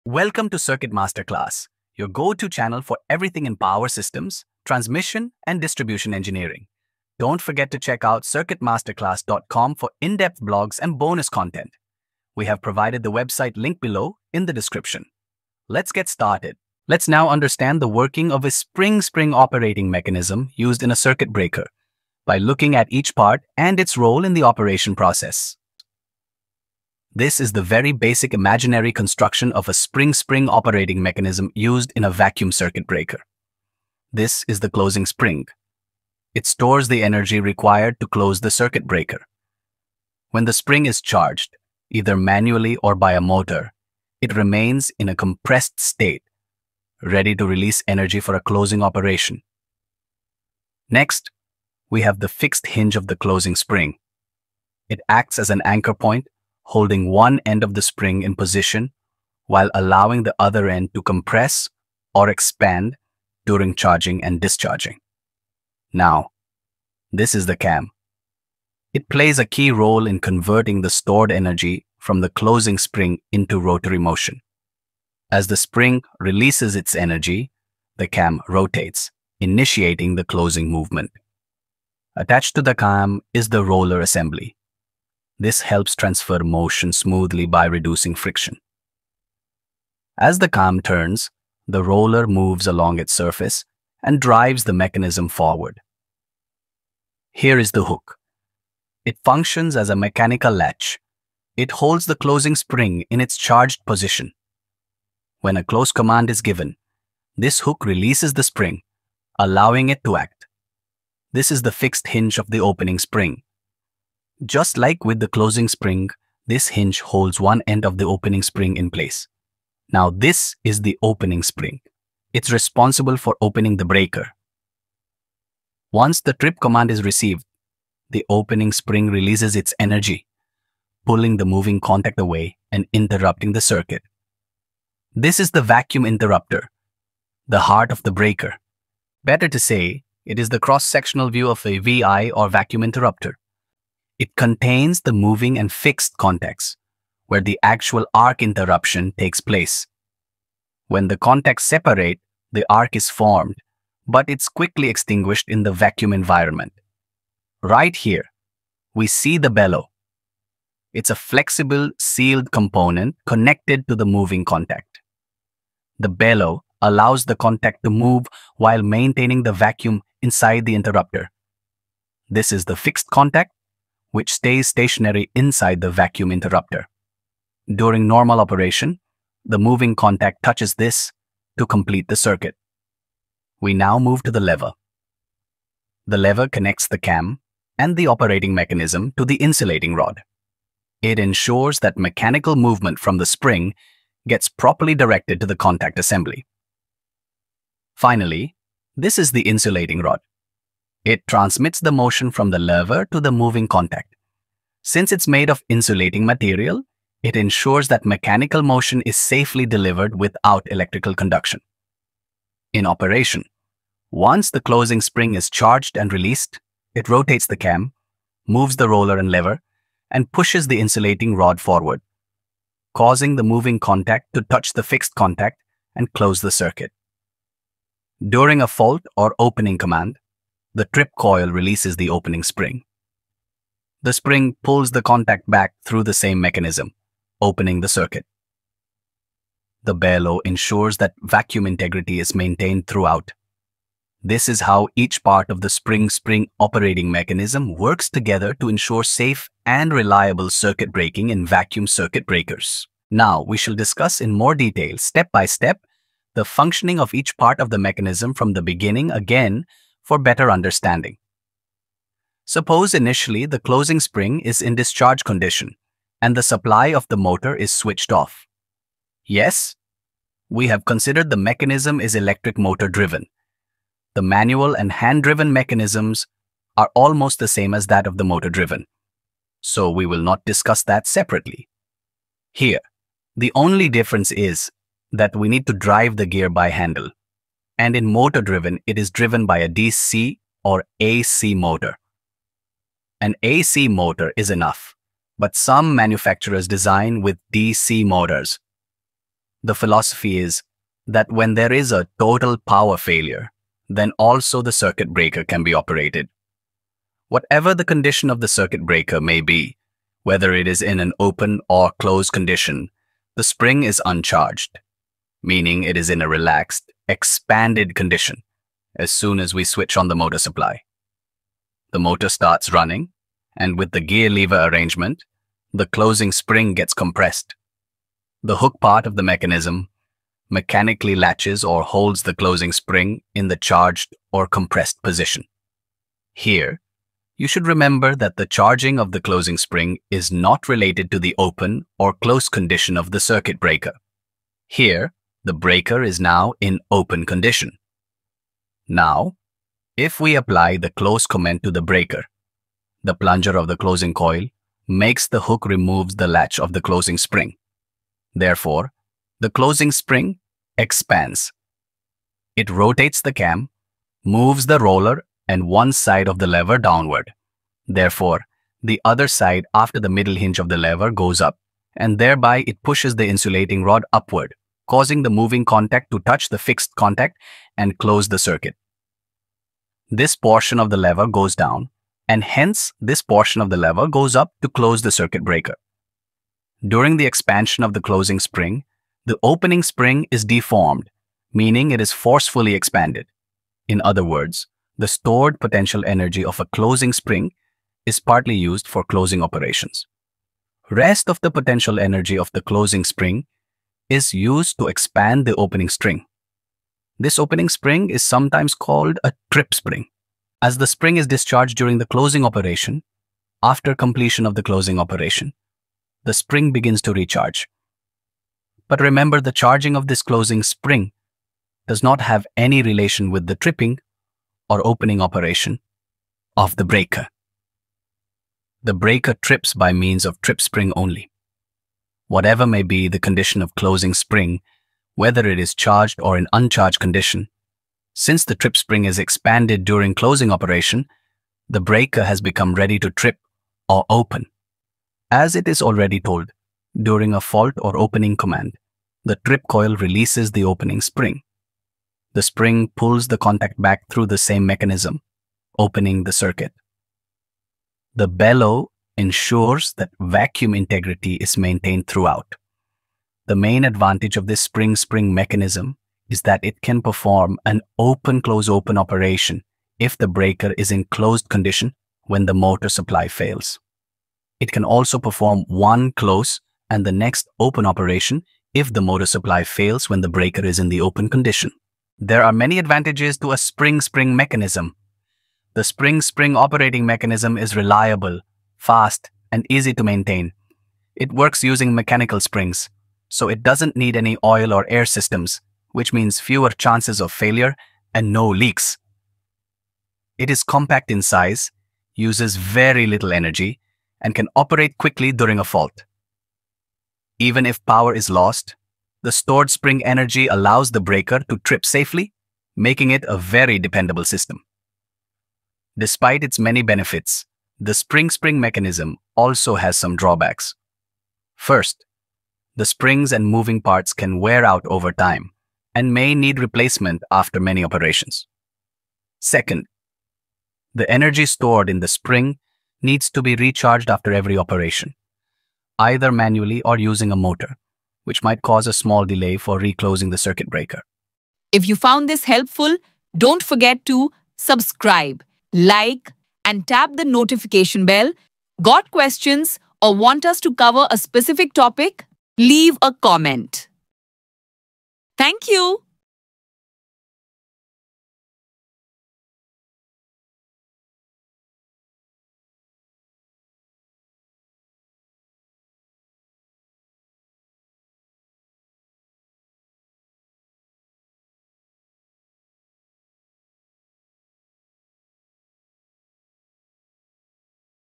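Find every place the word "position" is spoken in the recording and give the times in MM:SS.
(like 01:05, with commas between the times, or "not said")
00:58, 01:43, 05:35.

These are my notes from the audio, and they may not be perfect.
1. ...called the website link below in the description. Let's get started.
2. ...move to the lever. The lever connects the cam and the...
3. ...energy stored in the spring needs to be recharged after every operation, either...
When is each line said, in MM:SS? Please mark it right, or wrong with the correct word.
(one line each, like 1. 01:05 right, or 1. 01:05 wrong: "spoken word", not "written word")
1. 00:12 wrong: "provided", not "called"
2. 03:03 right
3. 08:51 right.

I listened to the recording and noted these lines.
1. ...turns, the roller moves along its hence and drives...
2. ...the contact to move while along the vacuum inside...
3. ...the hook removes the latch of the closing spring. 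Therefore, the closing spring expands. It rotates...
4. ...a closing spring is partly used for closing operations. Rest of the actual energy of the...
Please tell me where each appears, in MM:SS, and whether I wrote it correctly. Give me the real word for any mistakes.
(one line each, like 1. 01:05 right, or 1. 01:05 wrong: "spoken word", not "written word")
1. 01:30 wrong: "surface", not "hence"
2. 02:47 wrong: "maintaining", not "along"
3. 05:55 right
4. 06:36 wrong: "potential", not "actual".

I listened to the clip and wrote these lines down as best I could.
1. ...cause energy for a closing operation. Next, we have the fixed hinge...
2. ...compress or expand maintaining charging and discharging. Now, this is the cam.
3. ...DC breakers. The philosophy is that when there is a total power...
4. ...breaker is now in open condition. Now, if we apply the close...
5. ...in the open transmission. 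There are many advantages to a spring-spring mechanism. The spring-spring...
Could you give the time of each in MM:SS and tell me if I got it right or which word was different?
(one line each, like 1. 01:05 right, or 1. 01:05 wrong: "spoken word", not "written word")
1. 00:47 wrong: "release", not "cause"
2. 01:01 wrong: "during", not "maintaining"
3. 04:57 wrong: "motors", not "breakers"
4. 05:45 right
5. 08:00 wrong: "condition", not "transmission".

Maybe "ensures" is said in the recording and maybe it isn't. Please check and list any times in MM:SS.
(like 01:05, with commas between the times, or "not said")
03:11, 03:27, 04:00, 04:08, 07:39.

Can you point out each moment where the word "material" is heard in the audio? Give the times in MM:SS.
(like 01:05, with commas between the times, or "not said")
03:26.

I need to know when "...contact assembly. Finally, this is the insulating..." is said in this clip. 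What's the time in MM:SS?
03:15.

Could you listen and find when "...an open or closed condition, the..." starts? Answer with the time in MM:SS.
05:10.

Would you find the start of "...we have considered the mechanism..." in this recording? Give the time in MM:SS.
04:30.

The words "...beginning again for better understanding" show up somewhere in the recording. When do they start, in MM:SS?
04:18.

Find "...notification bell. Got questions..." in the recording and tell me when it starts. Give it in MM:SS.
09:07.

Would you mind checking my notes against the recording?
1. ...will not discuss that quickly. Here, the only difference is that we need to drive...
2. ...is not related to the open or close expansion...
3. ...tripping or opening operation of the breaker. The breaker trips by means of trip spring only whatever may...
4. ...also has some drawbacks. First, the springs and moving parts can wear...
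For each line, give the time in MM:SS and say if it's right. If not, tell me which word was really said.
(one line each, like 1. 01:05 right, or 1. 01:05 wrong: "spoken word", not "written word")
1. 04:40 wrong: "separately", not "quickly"
2. 05:40 wrong: "condition", not "expansion"
3. 07:03 right
4. 08:39 right.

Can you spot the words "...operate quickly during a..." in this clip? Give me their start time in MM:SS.
08:24.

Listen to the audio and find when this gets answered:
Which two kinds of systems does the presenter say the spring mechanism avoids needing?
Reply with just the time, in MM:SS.
08:14.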